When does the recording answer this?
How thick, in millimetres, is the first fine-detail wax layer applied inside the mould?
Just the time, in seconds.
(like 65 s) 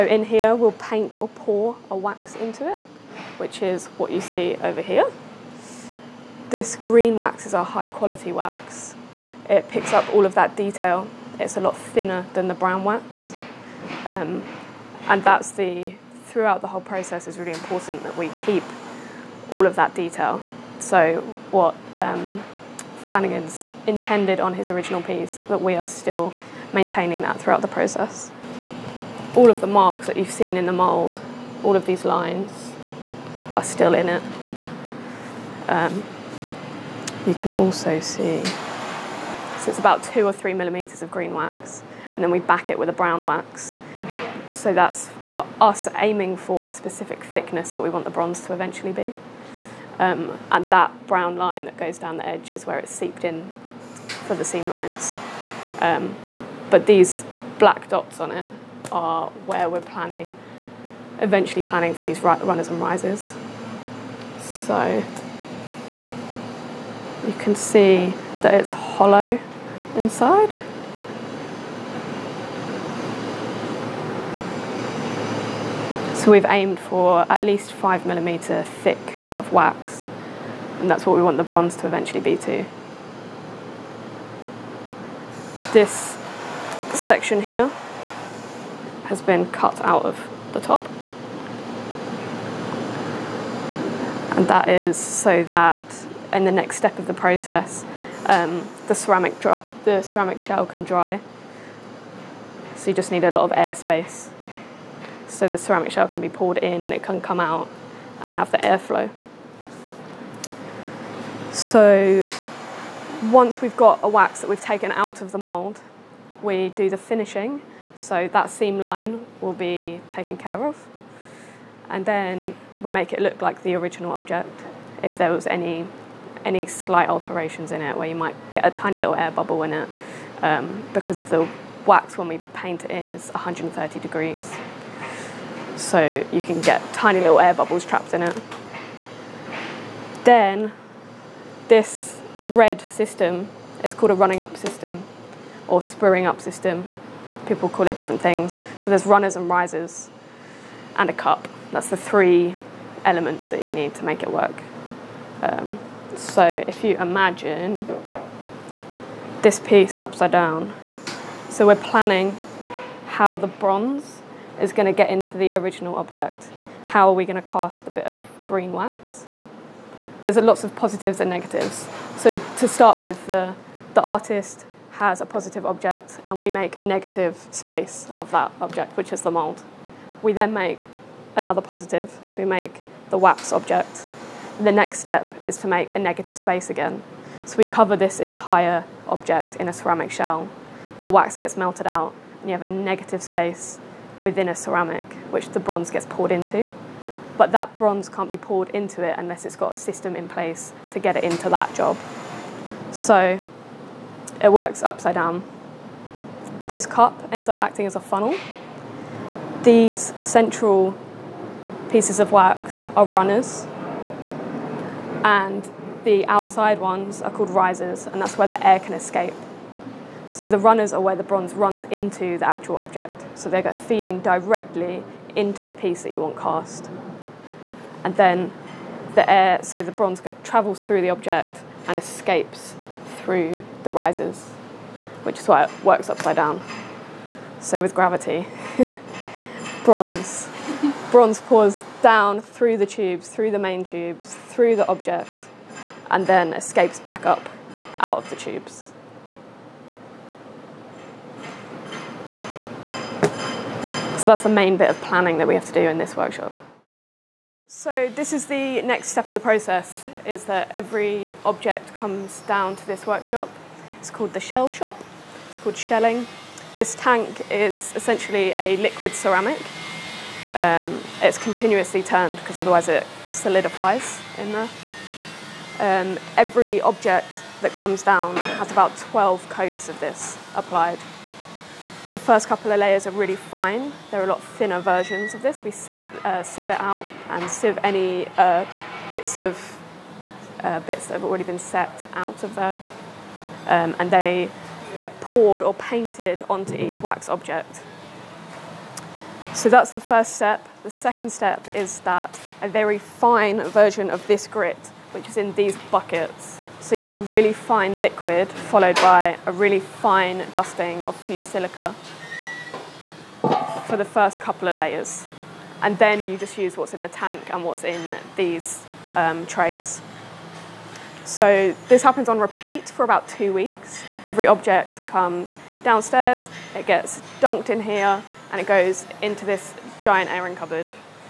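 40 s.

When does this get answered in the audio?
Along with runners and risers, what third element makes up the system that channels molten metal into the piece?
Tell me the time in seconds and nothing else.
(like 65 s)
151 s.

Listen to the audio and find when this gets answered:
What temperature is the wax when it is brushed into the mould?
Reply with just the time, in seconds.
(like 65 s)
133 s.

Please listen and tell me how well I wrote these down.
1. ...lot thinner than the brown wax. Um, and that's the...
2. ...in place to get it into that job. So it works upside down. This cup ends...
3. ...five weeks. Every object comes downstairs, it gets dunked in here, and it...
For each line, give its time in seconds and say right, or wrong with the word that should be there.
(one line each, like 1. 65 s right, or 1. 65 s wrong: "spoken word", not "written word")
1. 11 s right
2. 200 s right
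3. 323 s wrong: "two", not "five".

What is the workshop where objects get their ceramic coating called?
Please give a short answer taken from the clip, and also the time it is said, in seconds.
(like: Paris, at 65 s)
The shell shop, at 264 s.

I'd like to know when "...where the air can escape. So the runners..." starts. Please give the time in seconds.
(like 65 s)
218 s.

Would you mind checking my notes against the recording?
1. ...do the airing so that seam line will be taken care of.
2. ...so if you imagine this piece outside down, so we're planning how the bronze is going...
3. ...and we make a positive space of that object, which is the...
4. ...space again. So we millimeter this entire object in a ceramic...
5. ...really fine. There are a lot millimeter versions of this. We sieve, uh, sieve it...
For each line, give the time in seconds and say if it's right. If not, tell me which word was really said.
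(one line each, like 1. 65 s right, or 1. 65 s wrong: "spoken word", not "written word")
1. 116 s wrong: "finishing", not "airing"
2. 156 s wrong: "upside", not "outside"
3. 176 s wrong: "negative", not "positive"
4. 186 s wrong: "cover", not "millimeter"
5. 283 s wrong: "thinner", not "millimeter".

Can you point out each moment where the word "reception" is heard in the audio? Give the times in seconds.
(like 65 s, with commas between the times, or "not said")
not said.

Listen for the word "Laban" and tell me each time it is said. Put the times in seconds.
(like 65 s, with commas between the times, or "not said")
not said.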